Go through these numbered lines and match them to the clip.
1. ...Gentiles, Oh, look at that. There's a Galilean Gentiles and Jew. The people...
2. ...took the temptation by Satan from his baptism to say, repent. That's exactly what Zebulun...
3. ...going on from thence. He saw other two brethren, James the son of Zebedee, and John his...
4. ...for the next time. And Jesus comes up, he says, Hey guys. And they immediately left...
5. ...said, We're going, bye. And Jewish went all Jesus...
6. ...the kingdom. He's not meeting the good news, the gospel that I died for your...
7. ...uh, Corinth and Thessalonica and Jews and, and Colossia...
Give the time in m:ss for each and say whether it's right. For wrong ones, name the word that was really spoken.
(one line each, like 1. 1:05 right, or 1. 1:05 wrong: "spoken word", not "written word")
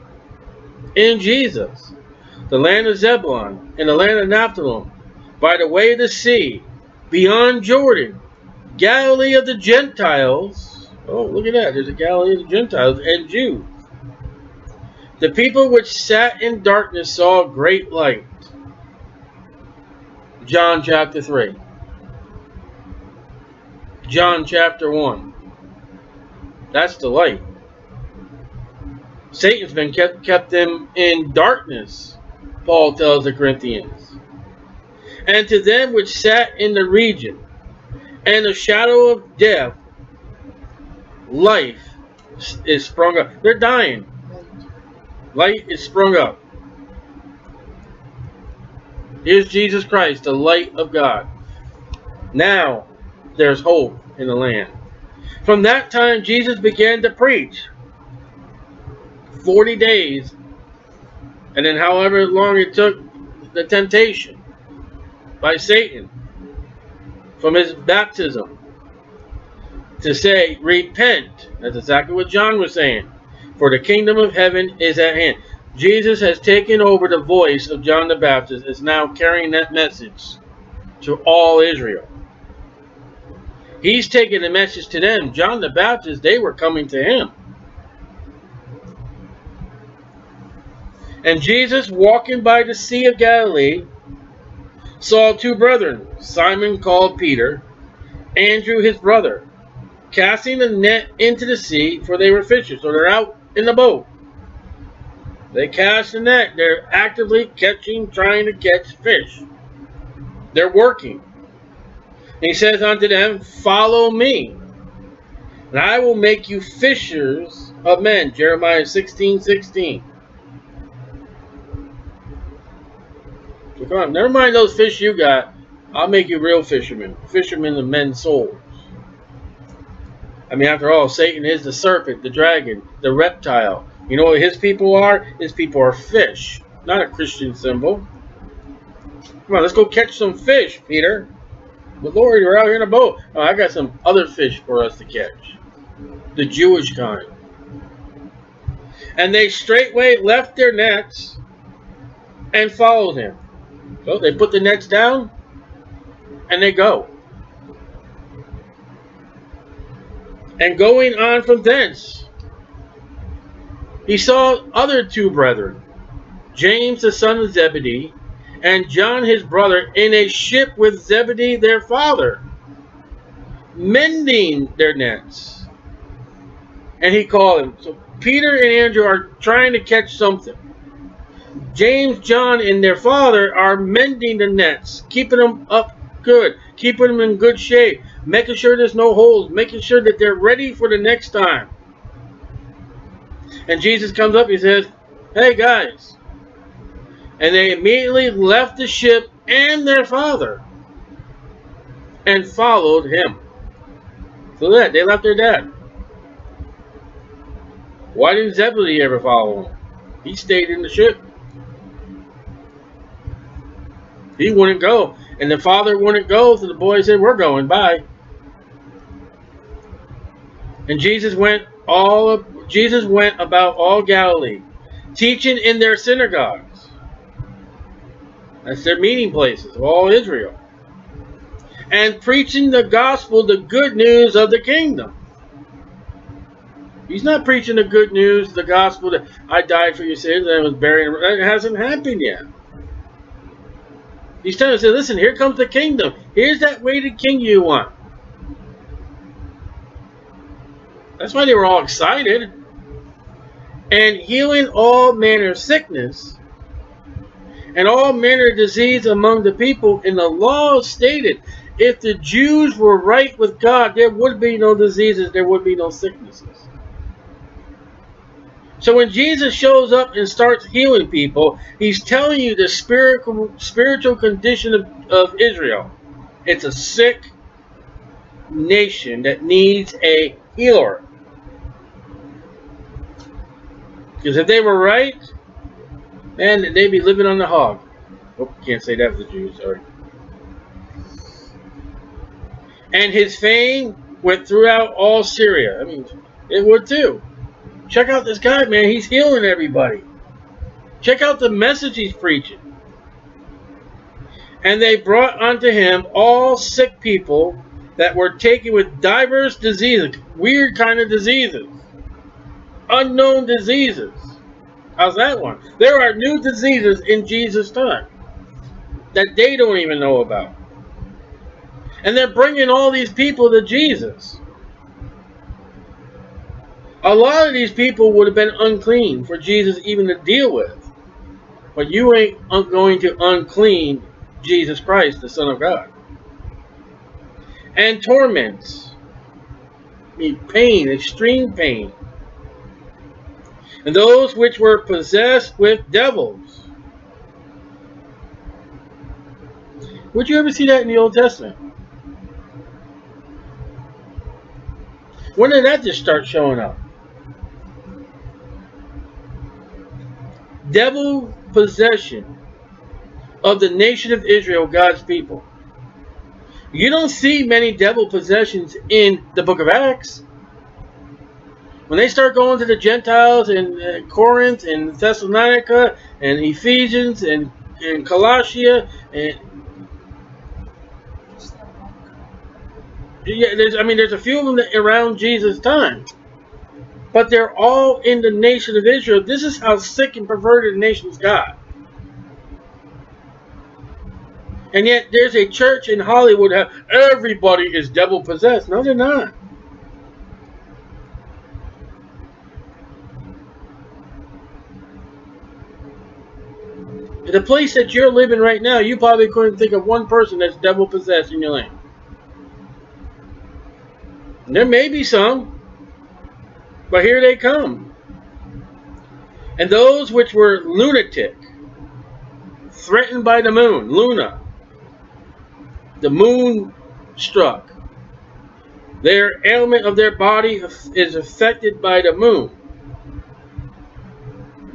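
1. 0:09 right
2. 1:02 wrong: "John", not "Zebulun"
3. 2:40 right
4. 3:10 right
5. 3:37 wrong: "Jesus", not "Jewish"
6. 3:54 wrong: "preaching", not "meeting"
7. 6:13 wrong: "Ephesians", not "Jews".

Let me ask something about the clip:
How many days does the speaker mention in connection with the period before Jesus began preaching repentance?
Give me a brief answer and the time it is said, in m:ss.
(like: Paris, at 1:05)
40, at 0:59.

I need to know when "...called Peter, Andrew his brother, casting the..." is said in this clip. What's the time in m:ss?
1:36.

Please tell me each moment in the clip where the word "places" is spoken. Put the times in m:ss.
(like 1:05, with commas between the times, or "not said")
3:49, 6:47.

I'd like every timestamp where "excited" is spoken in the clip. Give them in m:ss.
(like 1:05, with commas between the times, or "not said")
4:11.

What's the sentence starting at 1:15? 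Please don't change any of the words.
Jesus has taken over the voice of John the Baptist.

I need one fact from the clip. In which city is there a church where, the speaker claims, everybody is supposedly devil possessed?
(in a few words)
Hollywood.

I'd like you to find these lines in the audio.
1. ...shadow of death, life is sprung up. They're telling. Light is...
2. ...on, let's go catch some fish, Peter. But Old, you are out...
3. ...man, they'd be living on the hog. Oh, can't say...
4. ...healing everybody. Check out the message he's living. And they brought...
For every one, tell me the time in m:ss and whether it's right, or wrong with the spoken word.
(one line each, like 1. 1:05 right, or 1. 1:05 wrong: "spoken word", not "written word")
1. 0:38 wrong: "dying", not "telling"
2. 2:19 wrong: "Lord", not "Old"
3. 4:46 right
4. 4:59 wrong: "preaching", not "living".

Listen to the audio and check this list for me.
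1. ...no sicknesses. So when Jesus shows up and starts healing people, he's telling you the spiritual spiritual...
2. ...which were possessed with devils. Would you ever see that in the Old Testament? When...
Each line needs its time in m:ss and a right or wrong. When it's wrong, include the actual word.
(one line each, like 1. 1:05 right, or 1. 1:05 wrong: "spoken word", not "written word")
1. 4:25 right
2. 5:44 right.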